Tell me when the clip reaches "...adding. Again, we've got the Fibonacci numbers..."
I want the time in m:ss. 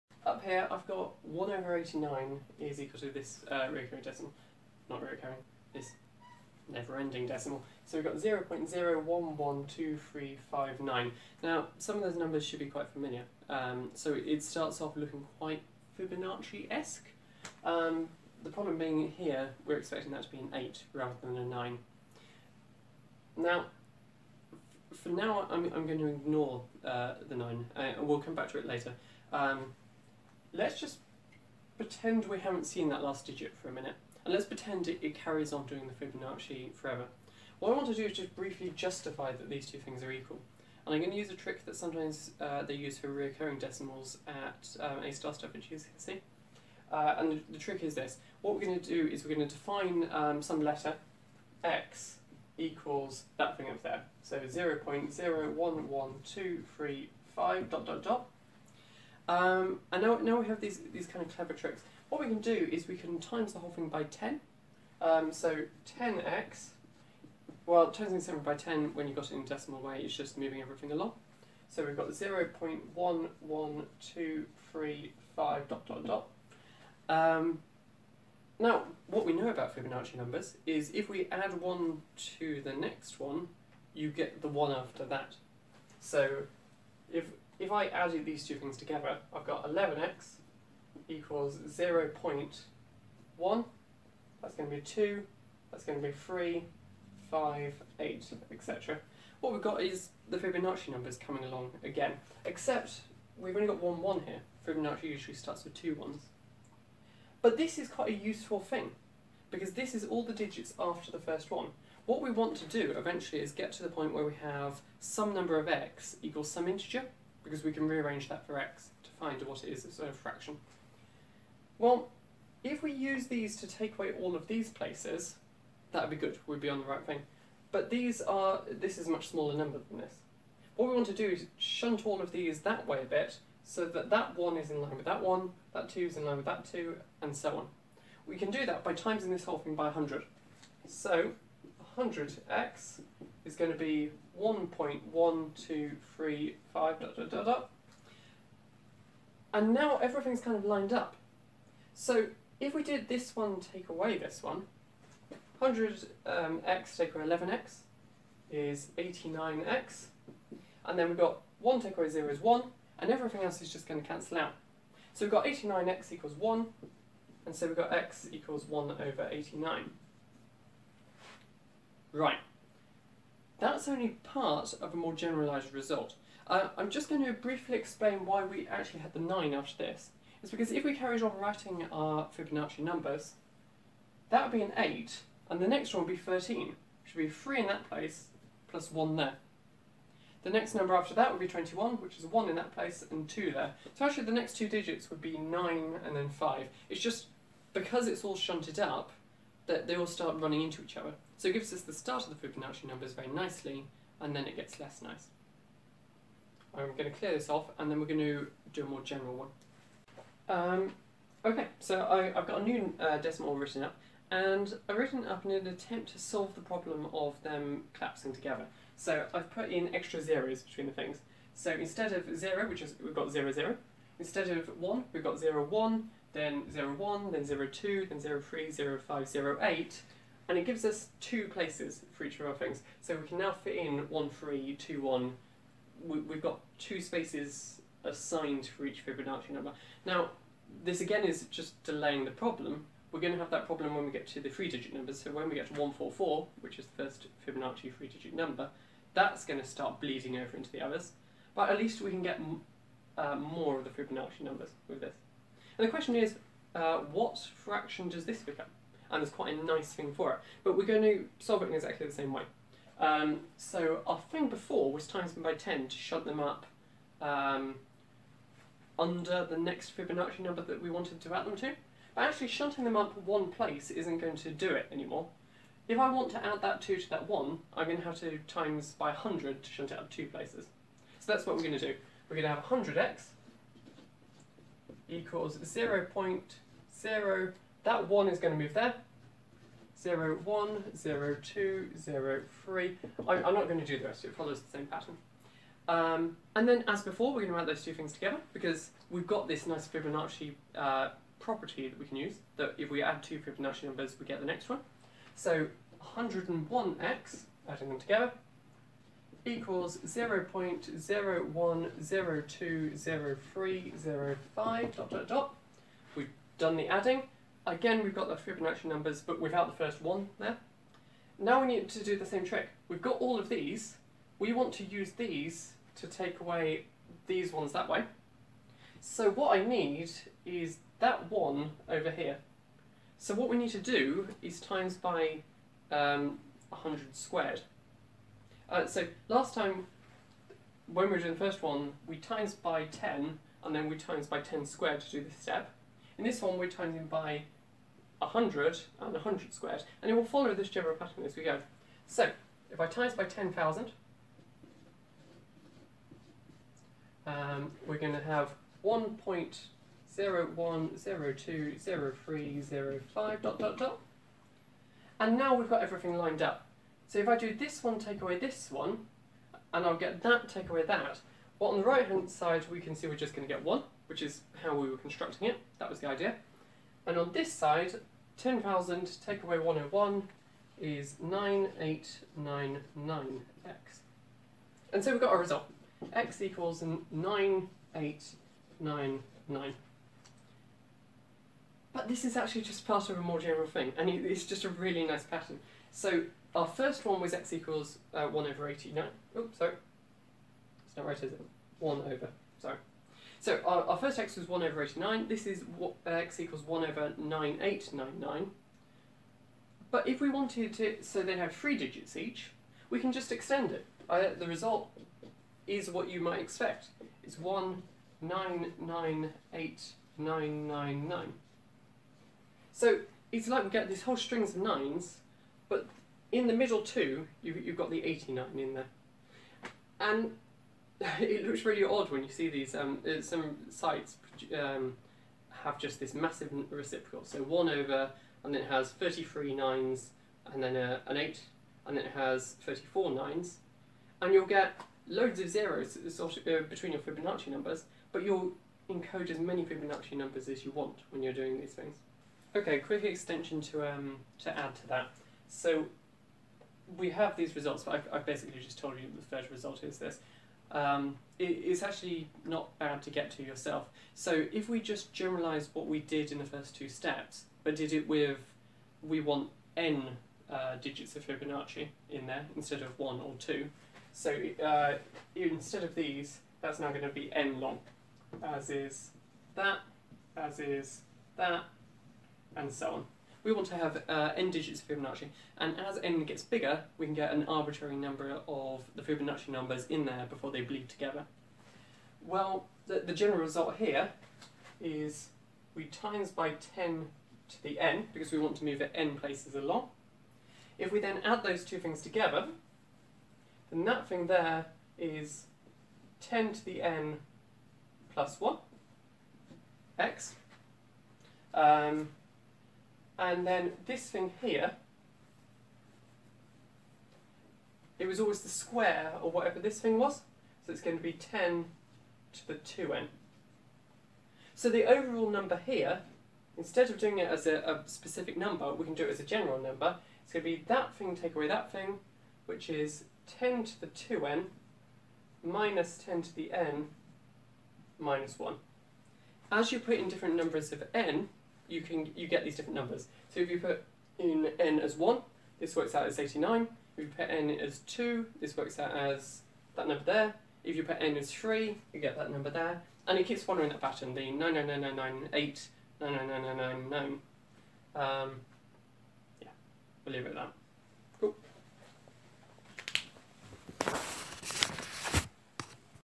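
5:16.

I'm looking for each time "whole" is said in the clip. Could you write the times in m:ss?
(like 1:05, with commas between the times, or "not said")
1:03, 2:19, 7:04.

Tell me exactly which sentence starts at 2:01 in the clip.
Well, if we use these to take away all of these places, that would be good, we'd be on the right thing.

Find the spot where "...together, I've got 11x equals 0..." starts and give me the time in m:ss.
1:28.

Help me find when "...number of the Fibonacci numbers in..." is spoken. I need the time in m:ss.
8:07.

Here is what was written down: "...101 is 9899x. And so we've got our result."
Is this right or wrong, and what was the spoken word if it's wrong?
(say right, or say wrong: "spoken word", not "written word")
right.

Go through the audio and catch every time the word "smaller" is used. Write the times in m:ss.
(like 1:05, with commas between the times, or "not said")
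2:09.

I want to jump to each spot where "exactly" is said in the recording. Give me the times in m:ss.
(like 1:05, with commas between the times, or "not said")
4:21.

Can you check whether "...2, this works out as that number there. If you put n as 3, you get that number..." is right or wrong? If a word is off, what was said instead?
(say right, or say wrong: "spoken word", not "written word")
right.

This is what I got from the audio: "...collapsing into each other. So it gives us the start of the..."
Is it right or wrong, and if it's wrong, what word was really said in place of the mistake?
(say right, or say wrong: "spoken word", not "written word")
wrong: "running", not "collapsing".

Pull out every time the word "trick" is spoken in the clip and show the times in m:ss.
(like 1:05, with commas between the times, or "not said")
0:41, 0:47, 1:01, 5:22.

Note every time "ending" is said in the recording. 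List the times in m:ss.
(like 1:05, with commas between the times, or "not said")
0:06.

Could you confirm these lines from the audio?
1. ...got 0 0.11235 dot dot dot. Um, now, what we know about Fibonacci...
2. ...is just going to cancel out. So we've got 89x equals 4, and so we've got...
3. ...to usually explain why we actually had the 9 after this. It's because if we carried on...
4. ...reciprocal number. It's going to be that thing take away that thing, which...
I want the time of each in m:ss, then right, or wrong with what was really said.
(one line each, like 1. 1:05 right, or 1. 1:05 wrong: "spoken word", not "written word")
1. 1:11 right
2. 2:43 wrong: "1", not "4"
3. 2:57 wrong: "briefly", not "usually"
4. 8:49 wrong: "general", not "reciprocal".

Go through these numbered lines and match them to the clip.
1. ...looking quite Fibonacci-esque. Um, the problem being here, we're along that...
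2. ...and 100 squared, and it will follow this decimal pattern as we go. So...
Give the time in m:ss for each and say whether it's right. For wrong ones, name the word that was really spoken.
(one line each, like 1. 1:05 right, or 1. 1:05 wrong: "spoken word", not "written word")
1. 0:14 wrong: "expecting", not "along"
2. 5:48 wrong: "general", not "decimal".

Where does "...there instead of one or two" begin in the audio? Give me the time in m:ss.
7:52.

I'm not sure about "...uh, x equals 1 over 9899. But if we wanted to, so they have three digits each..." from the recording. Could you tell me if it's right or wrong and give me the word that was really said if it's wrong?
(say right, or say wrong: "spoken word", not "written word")
right.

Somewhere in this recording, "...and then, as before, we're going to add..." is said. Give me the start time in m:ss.
4:56.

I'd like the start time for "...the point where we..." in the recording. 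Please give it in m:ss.
1:53.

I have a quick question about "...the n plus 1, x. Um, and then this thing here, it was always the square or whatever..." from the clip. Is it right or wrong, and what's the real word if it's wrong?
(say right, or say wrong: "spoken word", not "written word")
right.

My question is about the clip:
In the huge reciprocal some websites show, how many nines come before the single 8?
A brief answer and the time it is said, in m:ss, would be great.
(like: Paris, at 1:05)
33, at 7:18.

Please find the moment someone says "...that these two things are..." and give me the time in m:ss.
0:39.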